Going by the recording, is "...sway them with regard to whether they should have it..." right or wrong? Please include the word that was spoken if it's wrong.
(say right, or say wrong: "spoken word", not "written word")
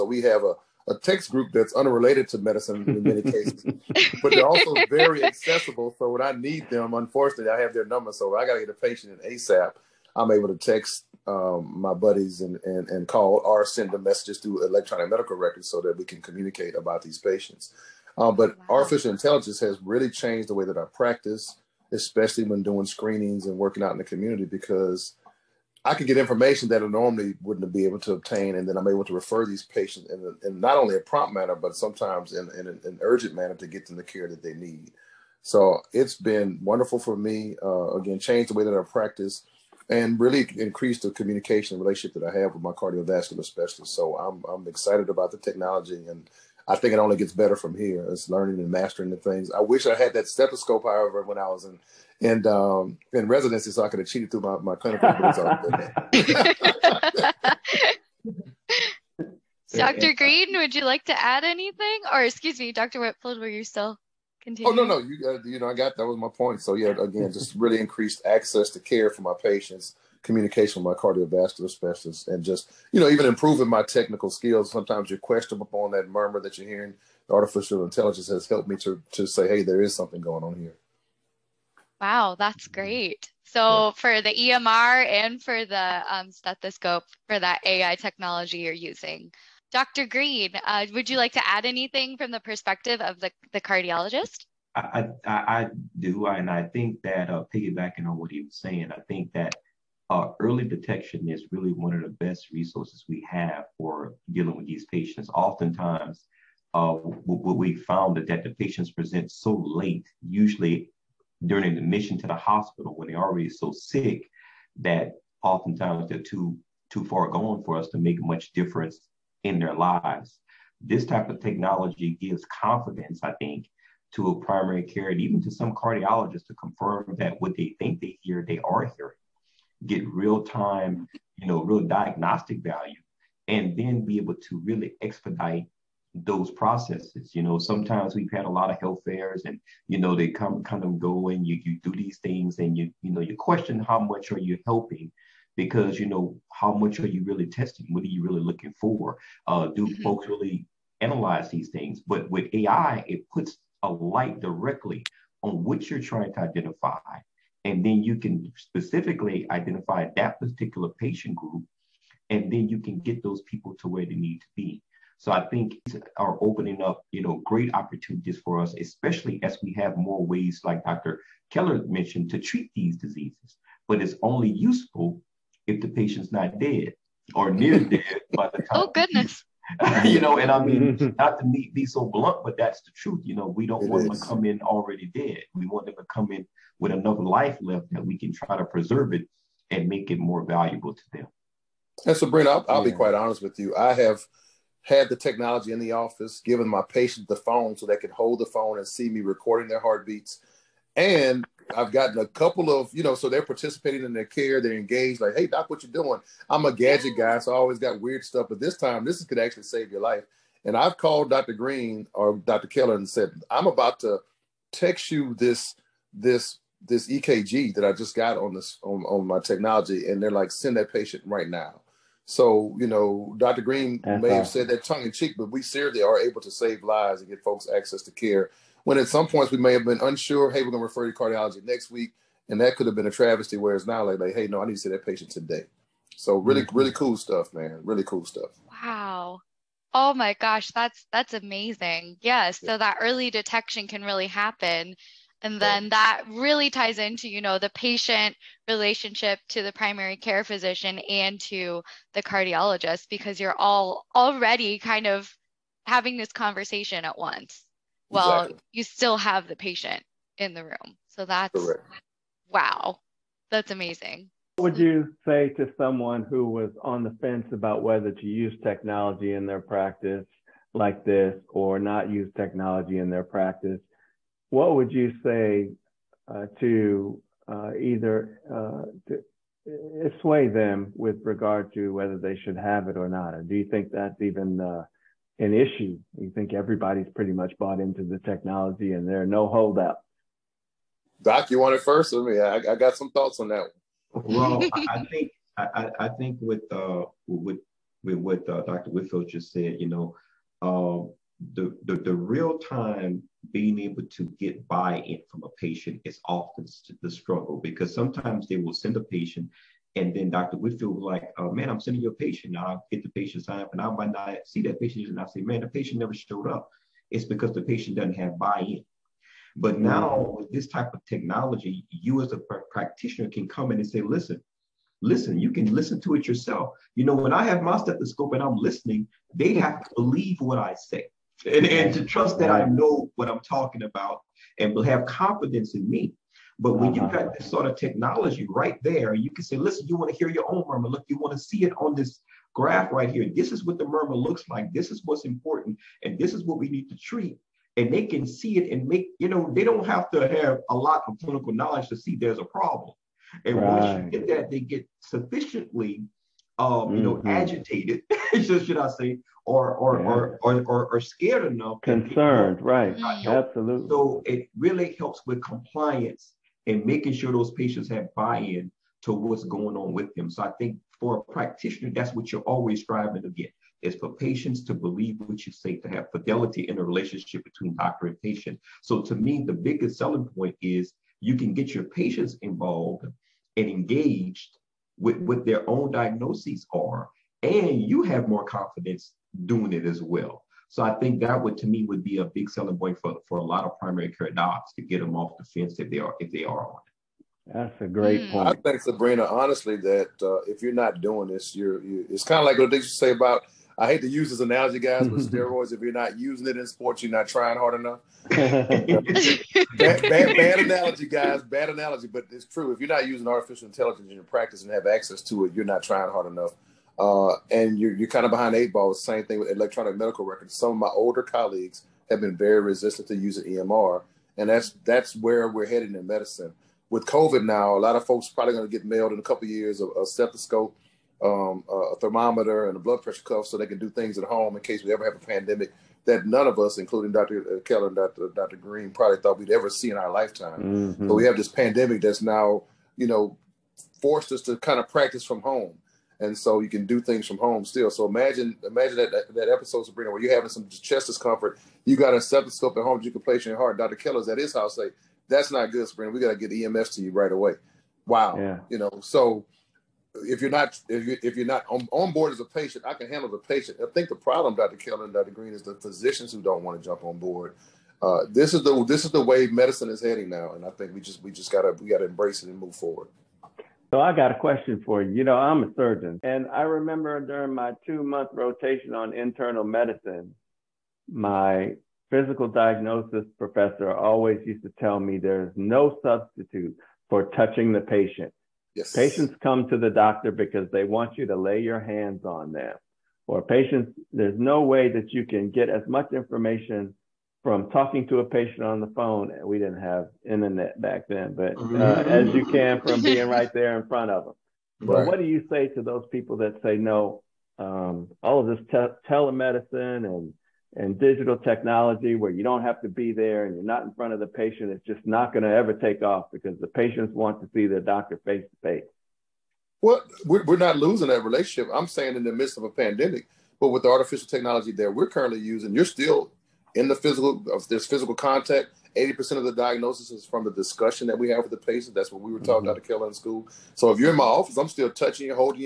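right.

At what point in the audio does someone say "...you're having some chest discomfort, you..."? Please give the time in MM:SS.
07:30.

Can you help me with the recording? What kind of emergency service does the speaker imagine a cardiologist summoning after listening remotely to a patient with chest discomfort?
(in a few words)
EMS.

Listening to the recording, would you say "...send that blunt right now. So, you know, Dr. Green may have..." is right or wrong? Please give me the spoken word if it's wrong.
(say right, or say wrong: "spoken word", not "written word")
wrong: "patient", not "blunt".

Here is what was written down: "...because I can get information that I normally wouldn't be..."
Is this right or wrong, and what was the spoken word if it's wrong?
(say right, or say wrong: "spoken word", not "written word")
right.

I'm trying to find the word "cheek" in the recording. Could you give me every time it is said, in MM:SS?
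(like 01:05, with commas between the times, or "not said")
03:45.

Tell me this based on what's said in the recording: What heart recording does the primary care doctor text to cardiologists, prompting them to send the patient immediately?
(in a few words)
EKG.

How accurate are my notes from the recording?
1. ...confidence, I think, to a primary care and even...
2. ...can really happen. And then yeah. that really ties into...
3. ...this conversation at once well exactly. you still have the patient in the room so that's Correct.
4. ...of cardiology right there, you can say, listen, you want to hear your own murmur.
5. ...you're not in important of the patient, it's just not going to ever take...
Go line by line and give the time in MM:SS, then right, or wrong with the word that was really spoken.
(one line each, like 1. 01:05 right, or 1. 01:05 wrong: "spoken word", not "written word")
1. 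02:02 right
2. 04:03 right
3. 04:16 right
4. 05:37 wrong: "technology", not "cardiology"
5. 08:33 wrong: "front", not "important".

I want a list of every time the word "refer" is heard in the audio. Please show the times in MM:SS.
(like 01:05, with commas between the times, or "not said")
00:29, 03:50.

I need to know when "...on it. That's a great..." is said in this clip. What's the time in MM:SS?
06:36.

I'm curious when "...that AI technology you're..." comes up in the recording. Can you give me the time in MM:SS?
01:27.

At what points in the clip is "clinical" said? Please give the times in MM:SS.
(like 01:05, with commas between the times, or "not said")
00:54, 05:51.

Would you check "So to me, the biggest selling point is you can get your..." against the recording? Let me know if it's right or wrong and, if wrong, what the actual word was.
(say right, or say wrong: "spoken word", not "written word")
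right.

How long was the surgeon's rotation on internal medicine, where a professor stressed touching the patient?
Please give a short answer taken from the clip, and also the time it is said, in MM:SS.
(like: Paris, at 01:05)
2 months, at 07:57.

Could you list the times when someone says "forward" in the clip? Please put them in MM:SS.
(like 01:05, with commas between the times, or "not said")
07:52.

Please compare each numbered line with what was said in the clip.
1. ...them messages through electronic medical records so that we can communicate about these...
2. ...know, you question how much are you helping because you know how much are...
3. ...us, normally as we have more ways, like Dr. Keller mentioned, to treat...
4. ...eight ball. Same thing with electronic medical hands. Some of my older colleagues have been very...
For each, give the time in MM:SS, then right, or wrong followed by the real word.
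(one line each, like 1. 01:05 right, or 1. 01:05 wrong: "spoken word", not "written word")
1. 00:13 right
2. 02:23 right
3. 02:48 wrong: "especially", not "normally"
4. 06:58 wrong: "records", not "hands".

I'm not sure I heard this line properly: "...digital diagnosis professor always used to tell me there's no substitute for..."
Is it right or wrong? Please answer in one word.
wrong.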